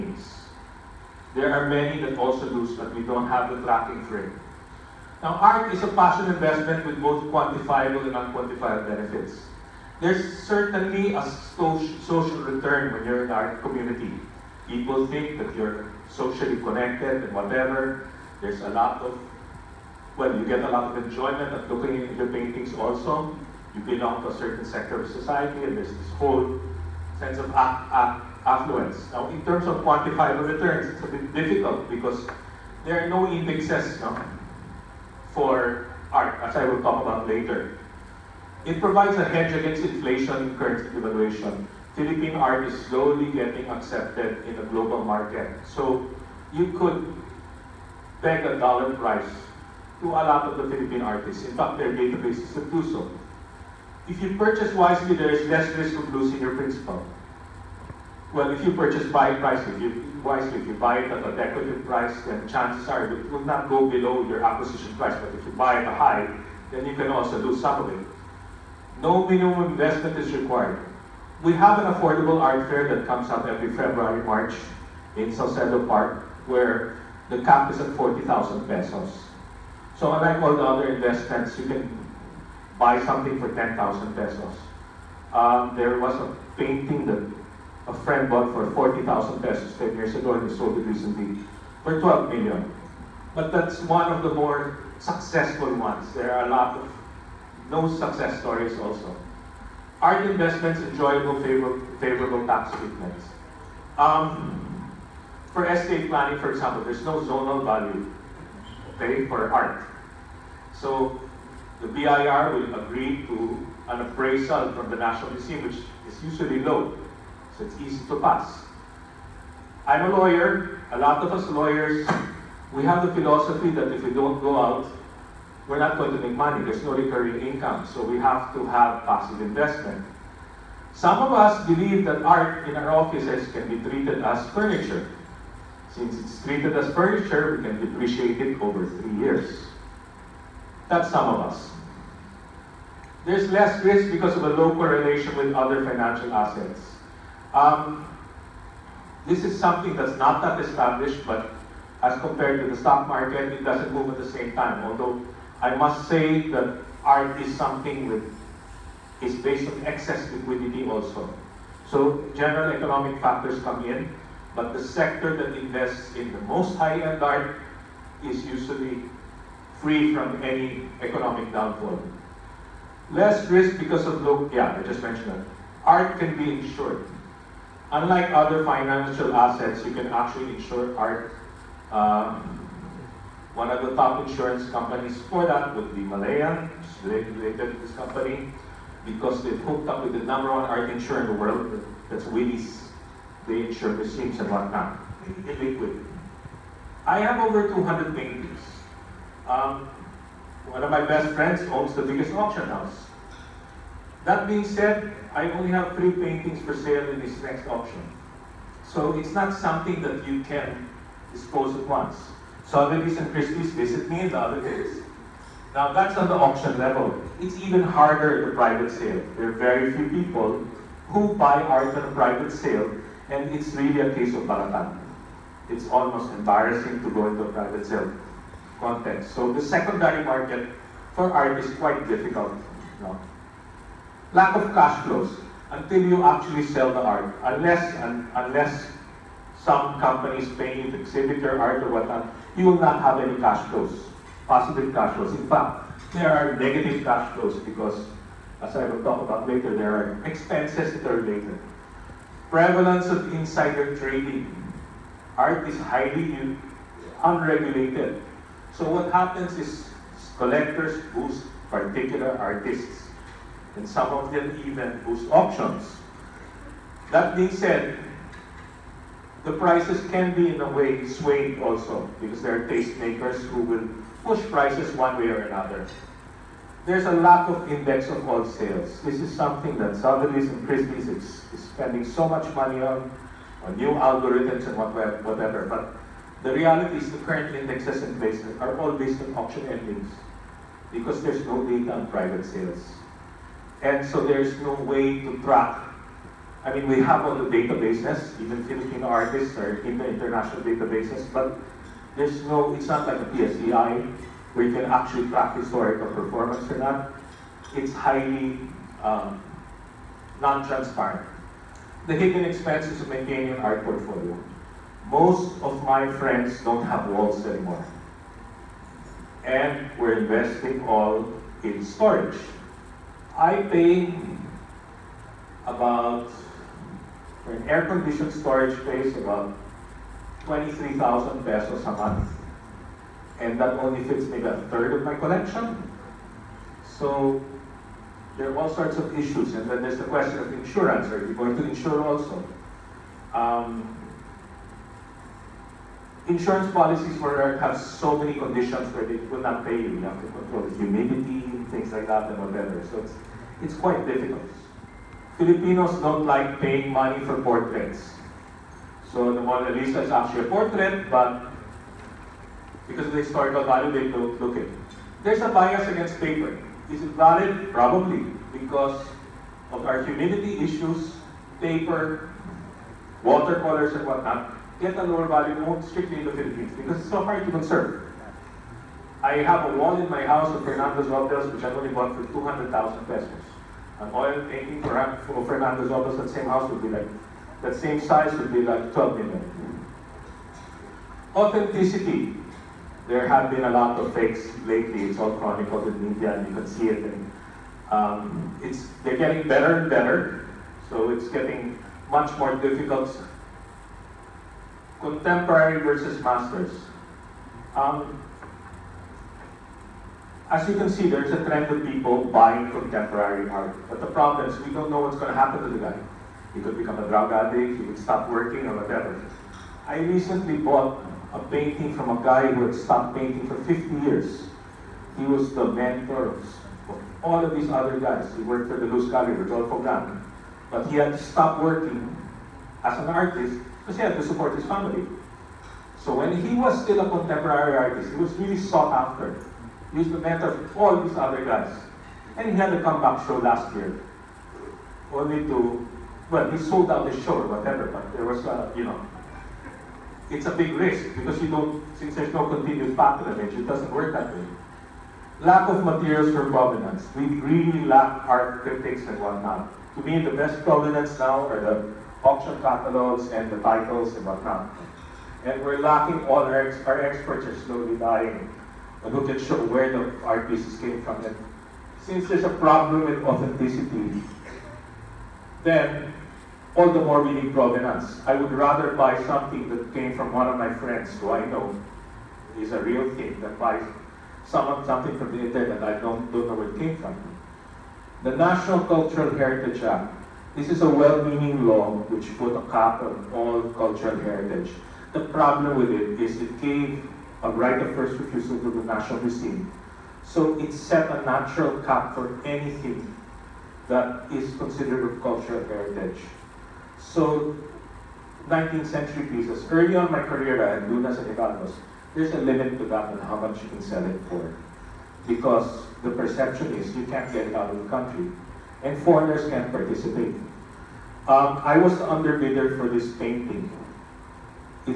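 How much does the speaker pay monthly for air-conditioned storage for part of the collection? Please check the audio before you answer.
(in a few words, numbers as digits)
23,000 pesos.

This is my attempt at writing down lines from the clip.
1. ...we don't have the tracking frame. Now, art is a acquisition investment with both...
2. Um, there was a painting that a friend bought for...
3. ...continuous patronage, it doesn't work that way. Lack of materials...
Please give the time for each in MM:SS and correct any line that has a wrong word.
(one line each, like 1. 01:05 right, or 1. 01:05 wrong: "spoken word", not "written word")
1. 00:02 wrong: "passion", not "acquisition"
2. 01:25 right
3. 07:32 right.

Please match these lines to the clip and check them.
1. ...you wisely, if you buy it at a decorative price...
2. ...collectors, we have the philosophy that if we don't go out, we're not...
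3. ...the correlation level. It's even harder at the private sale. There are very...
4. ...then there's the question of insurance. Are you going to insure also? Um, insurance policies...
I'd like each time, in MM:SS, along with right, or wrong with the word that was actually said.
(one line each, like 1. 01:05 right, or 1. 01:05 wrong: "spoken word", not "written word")
1. 00:59 right
2. 02:01 wrong: "lawyers", not "collectors"
3. 03:36 wrong: "auction", not "correlation"
4. 05:39 right.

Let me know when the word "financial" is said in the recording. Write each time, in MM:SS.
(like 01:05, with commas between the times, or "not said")
02:25, 02:58.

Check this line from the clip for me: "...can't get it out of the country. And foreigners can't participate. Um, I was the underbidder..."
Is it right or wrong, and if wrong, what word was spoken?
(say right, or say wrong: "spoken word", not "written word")
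right.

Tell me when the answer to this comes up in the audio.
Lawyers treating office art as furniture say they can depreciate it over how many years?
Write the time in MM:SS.
02:18.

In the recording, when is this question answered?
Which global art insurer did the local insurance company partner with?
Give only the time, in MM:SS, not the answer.
03:12.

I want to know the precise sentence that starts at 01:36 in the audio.
There are a lot of no success stories also.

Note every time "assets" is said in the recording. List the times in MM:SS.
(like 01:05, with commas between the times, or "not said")
02:26, 02:59.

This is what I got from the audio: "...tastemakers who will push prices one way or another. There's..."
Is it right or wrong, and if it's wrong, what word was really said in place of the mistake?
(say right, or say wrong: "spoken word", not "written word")
right.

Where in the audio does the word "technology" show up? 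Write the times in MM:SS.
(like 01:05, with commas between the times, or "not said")
not said.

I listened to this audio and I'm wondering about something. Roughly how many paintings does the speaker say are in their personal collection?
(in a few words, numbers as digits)
Over 200.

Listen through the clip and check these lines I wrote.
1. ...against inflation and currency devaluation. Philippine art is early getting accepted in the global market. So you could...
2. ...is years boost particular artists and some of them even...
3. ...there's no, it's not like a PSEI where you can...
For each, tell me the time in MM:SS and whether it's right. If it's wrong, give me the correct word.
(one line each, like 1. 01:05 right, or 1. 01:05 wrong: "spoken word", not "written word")
1. 00:39 wrong: "slowly", not "early"
2. 04:19 wrong: "collectors", not "years"
3. 05:02 right.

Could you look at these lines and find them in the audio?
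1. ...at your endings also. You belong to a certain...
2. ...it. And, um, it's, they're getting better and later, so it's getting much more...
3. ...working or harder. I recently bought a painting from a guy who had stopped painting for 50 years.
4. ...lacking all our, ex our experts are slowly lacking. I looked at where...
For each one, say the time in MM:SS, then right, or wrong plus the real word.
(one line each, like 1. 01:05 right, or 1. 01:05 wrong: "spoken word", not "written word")
1. 00:22 wrong: "paintings", not "endings"
2. 06:36 wrong: "better", not "later"
3. 06:58 wrong: "whatever", not "harder"
4. 07:45 wrong: "dying", not "lacking".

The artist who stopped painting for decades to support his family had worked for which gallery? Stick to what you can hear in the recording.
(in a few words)
Luz Gallery.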